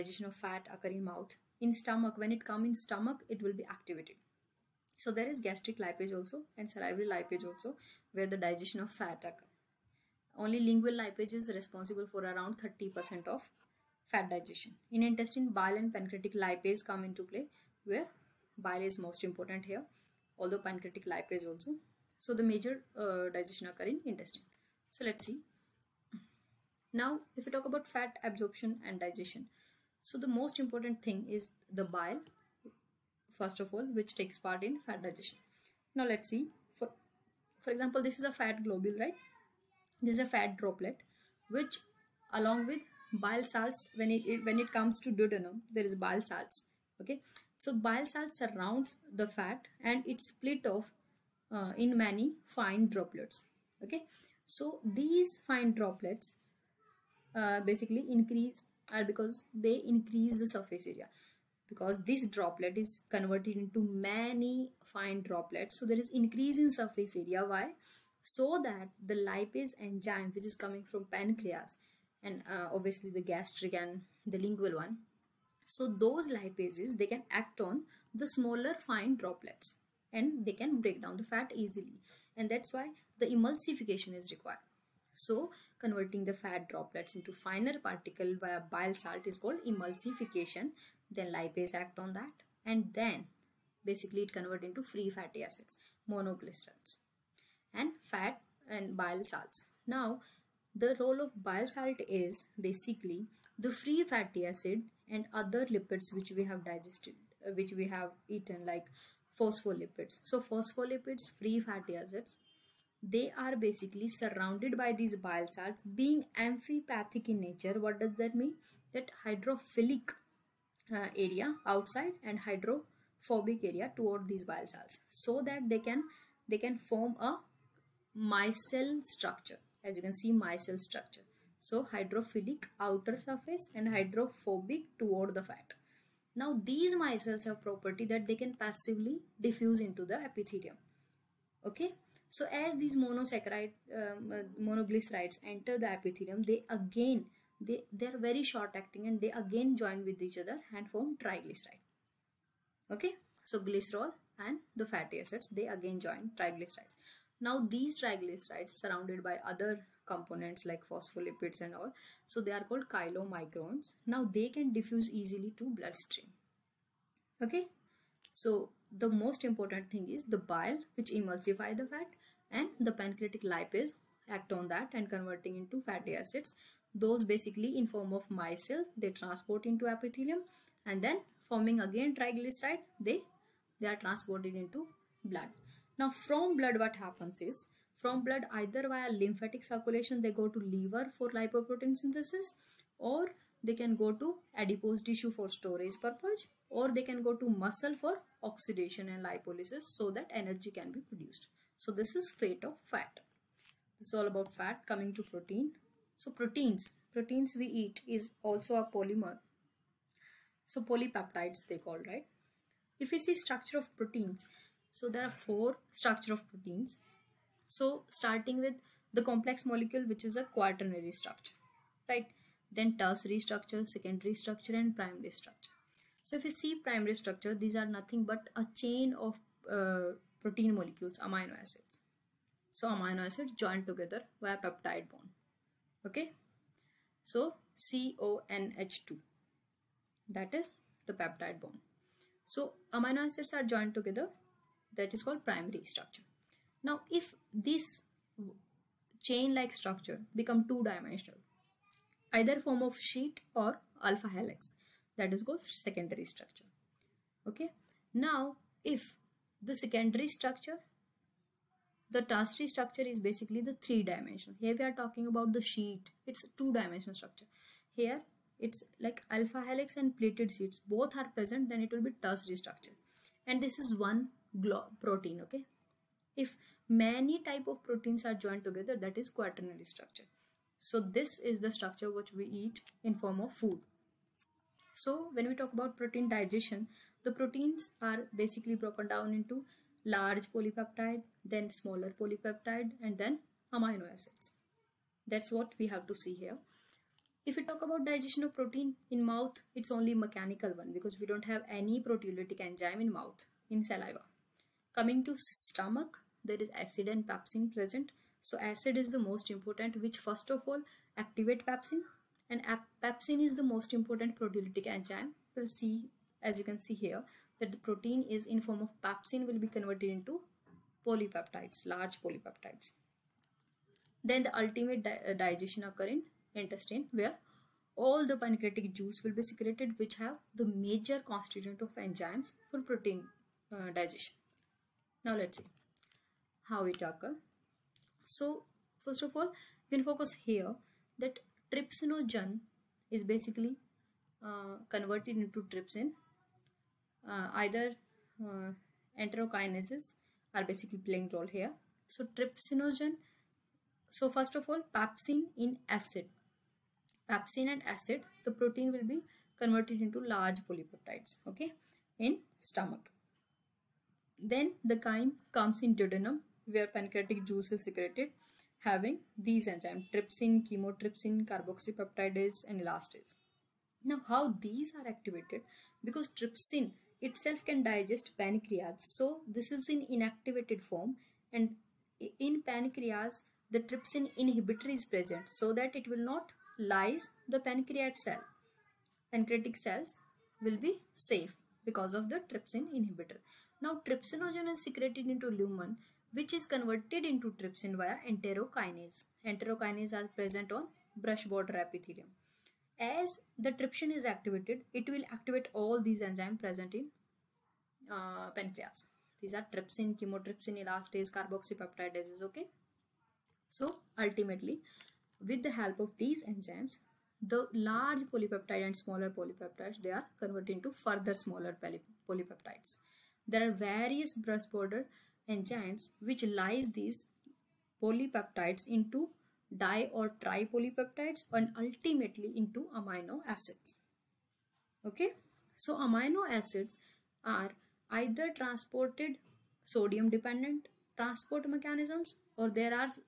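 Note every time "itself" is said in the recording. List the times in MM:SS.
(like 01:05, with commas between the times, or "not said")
06:17.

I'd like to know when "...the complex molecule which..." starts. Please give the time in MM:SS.
03:39.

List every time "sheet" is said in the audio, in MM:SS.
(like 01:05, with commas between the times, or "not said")
04:12, 04:25, 04:30.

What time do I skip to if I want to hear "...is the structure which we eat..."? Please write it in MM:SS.
04:41.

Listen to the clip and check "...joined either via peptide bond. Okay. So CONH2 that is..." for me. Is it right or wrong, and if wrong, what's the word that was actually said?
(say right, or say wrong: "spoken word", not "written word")
wrong: "together", not "either".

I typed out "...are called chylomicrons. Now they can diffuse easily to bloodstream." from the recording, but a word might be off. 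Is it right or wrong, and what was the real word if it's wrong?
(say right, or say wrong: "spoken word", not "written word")
right.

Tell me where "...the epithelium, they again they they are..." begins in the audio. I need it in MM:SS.
02:25.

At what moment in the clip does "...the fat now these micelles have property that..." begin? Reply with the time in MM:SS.
02:15.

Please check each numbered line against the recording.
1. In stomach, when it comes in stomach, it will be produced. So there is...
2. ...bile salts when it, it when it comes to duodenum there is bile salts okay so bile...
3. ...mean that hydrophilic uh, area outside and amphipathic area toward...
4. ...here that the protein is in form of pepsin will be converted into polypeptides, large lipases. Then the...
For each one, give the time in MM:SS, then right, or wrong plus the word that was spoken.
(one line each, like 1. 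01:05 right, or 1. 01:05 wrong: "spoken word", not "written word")
1. 00:01 wrong: "activated", not "produced"
2. 00:43 right
3. 01:58 wrong: "hydrophobic", not "amphipathic"
4. 05:16 wrong: "polypeptides", not "lipases".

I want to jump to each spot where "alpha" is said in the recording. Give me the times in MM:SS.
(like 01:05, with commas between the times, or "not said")
04:14, 04:29.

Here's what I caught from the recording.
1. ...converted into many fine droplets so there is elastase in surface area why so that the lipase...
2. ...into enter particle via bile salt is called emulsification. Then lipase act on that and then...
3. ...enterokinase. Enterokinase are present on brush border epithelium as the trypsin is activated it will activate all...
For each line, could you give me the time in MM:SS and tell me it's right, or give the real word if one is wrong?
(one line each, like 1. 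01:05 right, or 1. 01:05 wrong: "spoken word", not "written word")
1. 01:03 wrong: "increase", not "elastase"
2. 01:27 wrong: "finer", not "enter"
3. 06:38 right.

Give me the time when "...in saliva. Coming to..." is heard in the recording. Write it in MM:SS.
05:03.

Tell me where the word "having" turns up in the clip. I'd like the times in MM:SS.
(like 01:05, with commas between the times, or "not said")
06:08.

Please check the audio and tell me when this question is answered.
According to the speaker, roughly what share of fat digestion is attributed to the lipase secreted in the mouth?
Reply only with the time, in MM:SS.
00:12.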